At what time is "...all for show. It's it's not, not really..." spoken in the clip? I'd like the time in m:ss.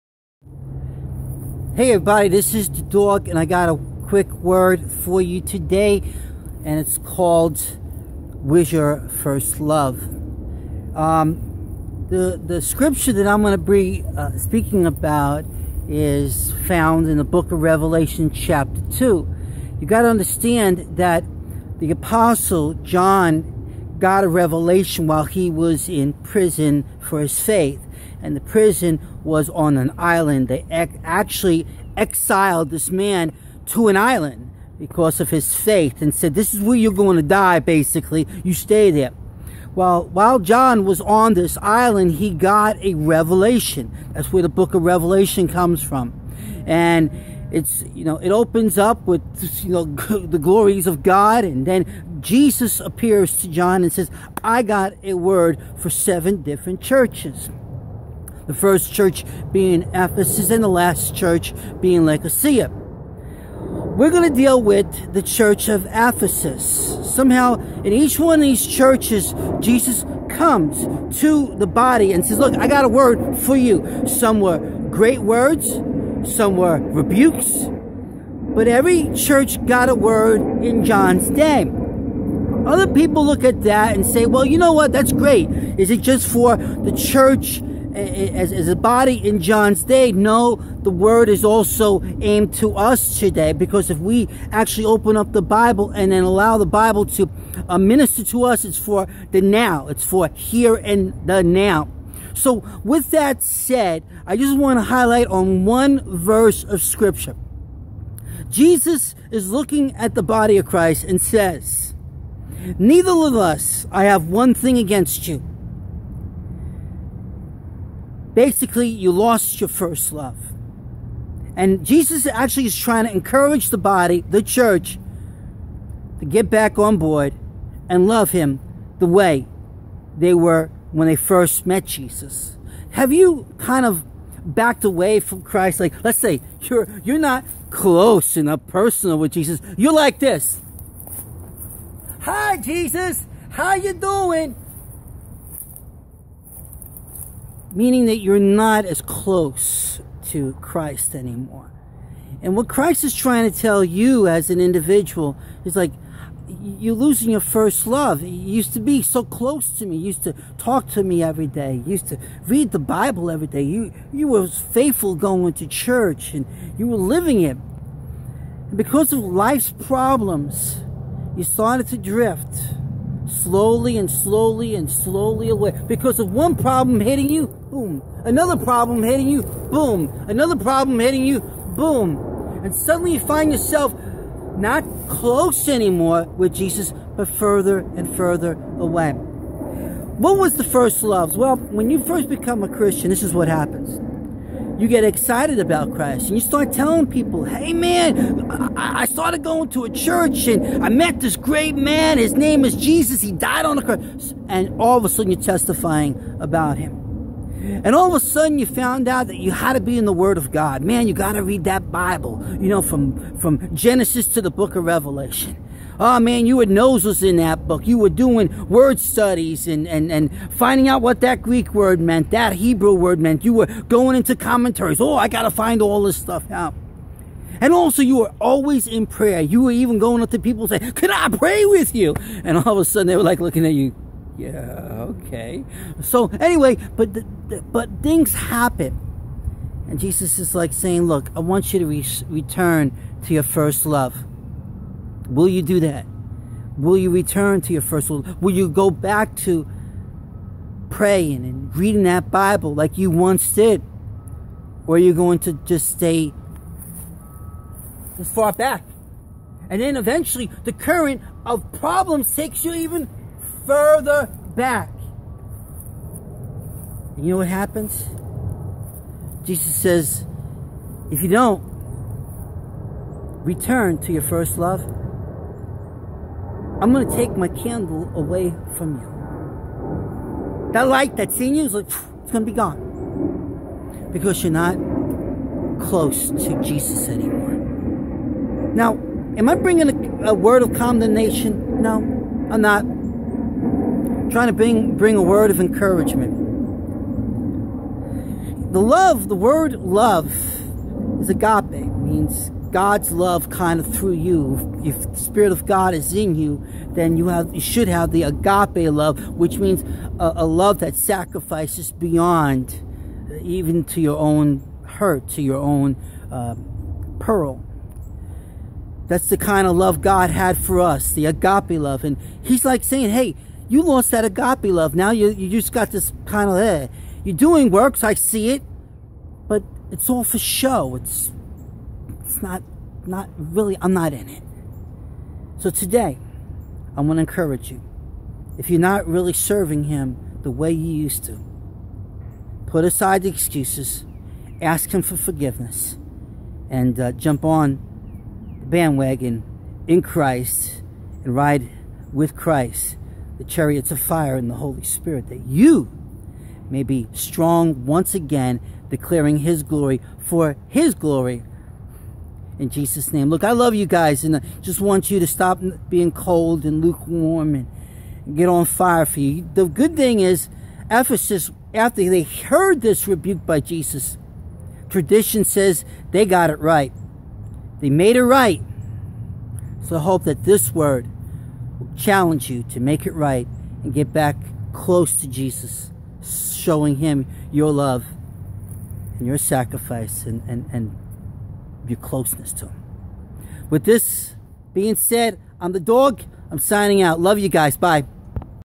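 5:30.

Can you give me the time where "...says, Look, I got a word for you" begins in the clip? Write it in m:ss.
1:12.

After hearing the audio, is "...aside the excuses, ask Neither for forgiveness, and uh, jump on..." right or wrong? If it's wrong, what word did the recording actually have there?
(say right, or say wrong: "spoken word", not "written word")
wrong: "Him", not "Neither".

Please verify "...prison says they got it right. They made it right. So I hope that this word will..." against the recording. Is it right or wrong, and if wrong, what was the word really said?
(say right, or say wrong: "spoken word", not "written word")
wrong: "tradition", not "prison".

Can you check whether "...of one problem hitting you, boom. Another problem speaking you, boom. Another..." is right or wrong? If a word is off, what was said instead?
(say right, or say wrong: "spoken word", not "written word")
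wrong: "hitting", not "speaking".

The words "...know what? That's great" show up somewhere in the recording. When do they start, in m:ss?
1:24.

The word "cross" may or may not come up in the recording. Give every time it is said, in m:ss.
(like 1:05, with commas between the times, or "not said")
3:23.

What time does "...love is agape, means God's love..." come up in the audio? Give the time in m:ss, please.
4:59.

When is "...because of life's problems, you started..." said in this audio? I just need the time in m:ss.
2:48.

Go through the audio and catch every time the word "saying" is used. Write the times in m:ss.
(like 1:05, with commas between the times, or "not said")
3:50, 4:00, 5:22.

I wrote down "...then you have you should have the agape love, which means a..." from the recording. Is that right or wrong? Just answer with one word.
right.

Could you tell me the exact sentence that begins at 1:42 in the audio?
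So, with that said, I just want to highlight on one verse of Scripture.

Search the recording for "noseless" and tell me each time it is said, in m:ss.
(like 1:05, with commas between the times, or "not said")
3:36.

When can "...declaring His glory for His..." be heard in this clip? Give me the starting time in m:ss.
5:58.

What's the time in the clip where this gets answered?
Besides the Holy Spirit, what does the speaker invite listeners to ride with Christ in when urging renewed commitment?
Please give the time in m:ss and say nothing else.
5:53.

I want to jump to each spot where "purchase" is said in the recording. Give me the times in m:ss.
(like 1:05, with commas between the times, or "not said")
not said.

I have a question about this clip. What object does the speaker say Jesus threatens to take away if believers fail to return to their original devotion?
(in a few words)
candle.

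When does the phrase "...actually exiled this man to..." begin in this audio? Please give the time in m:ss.
0:31.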